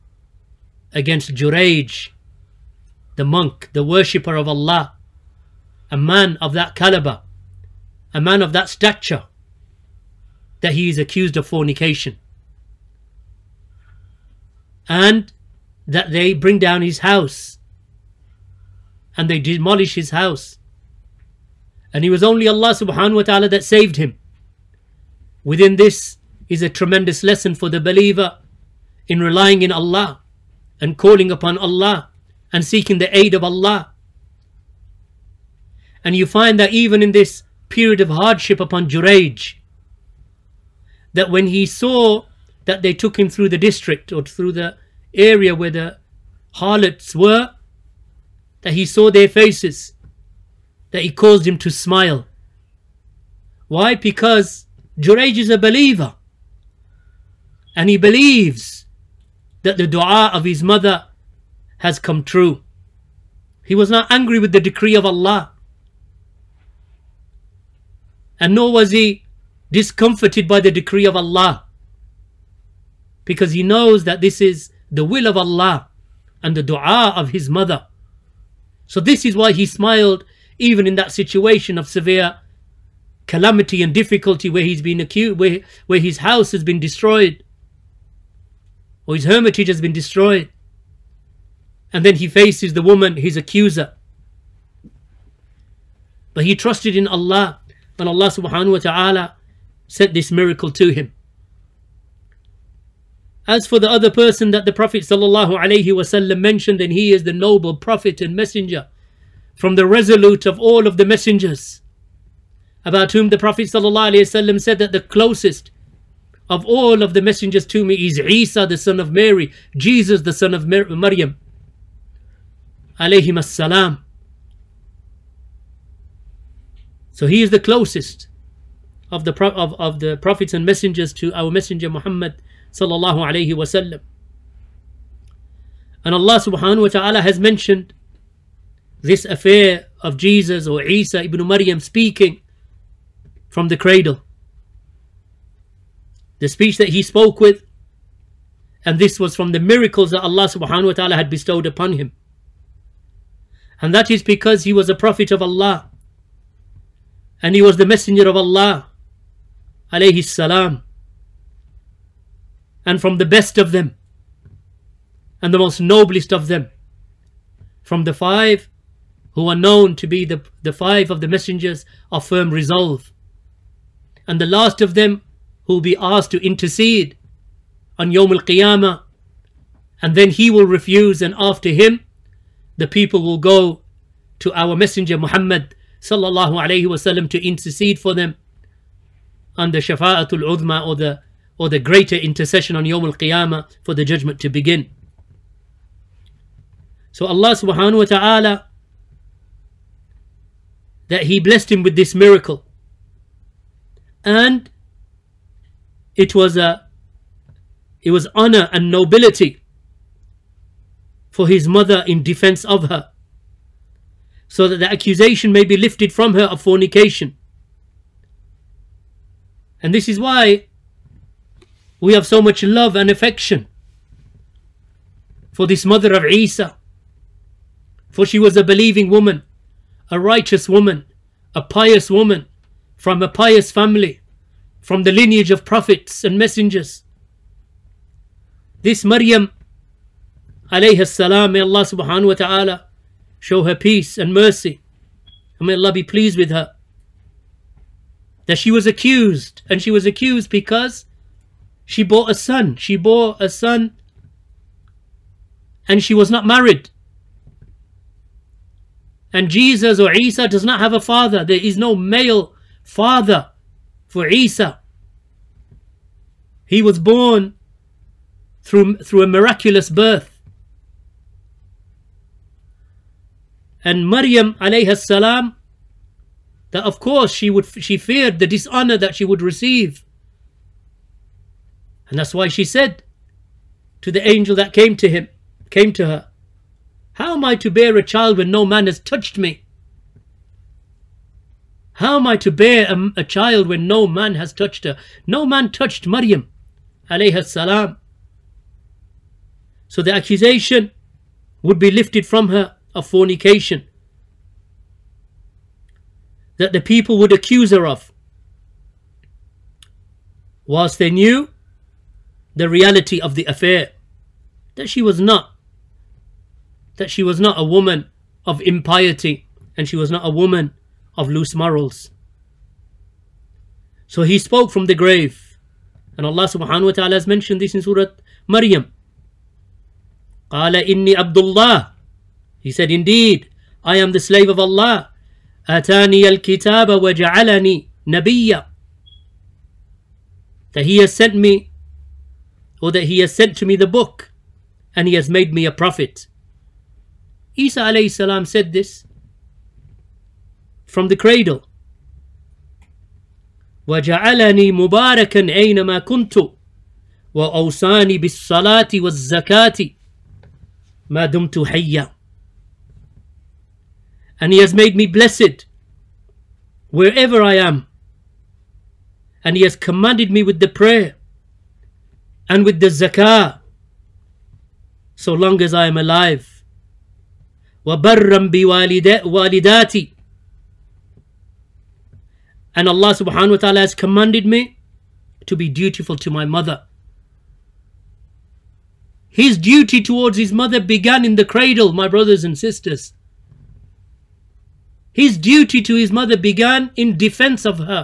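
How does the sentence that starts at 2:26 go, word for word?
The speech that he spoke with, and this was from the miracles that Allah subhanahu wa ta'ala had bestowed upon him.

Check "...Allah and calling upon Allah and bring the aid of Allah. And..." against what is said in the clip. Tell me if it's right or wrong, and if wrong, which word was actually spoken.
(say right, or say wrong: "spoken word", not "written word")
wrong: "seeking", not "bring".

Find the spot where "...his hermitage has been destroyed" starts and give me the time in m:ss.
1:29.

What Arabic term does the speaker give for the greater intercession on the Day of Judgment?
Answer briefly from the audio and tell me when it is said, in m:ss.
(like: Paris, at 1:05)
shafa'atul udma, at 3:09.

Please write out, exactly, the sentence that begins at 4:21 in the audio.
There is no male father for Isa.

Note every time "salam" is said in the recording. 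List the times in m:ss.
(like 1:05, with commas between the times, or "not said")
2:40, 4:01, 4:34, 4:57, 5:48.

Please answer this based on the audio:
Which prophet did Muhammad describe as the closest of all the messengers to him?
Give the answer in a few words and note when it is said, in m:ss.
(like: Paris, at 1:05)
Isa the son of Mary, at 1:58.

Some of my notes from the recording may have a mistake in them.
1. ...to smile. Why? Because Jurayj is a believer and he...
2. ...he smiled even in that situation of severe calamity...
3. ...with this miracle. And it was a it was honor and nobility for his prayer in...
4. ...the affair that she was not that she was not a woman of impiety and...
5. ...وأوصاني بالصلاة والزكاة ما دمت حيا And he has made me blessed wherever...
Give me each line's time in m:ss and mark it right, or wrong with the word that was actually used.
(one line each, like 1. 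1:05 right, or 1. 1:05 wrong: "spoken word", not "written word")
1. 0:51 right
2. 1:19 right
3. 3:21 wrong: "mother", not "prayer"
4. 5:13 right
5. 5:57 right.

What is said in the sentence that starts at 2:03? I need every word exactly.
Alayhim So he is the closest of the, of, of the prophets and messengers to our messenger Muhammad sallallahu alayhi wasallam.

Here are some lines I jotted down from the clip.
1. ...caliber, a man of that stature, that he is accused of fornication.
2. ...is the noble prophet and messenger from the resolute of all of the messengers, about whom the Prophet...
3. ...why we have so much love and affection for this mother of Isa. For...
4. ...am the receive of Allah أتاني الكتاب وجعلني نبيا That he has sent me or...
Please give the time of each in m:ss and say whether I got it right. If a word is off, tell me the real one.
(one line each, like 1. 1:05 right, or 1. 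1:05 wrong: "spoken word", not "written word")
1. 0:06 right
2. 1:47 right
3. 3:40 right
4. 5:33 wrong: "slave", not "receive".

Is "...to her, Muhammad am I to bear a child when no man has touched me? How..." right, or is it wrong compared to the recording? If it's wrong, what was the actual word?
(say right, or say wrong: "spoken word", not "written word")
wrong: "How", not "Muhammad".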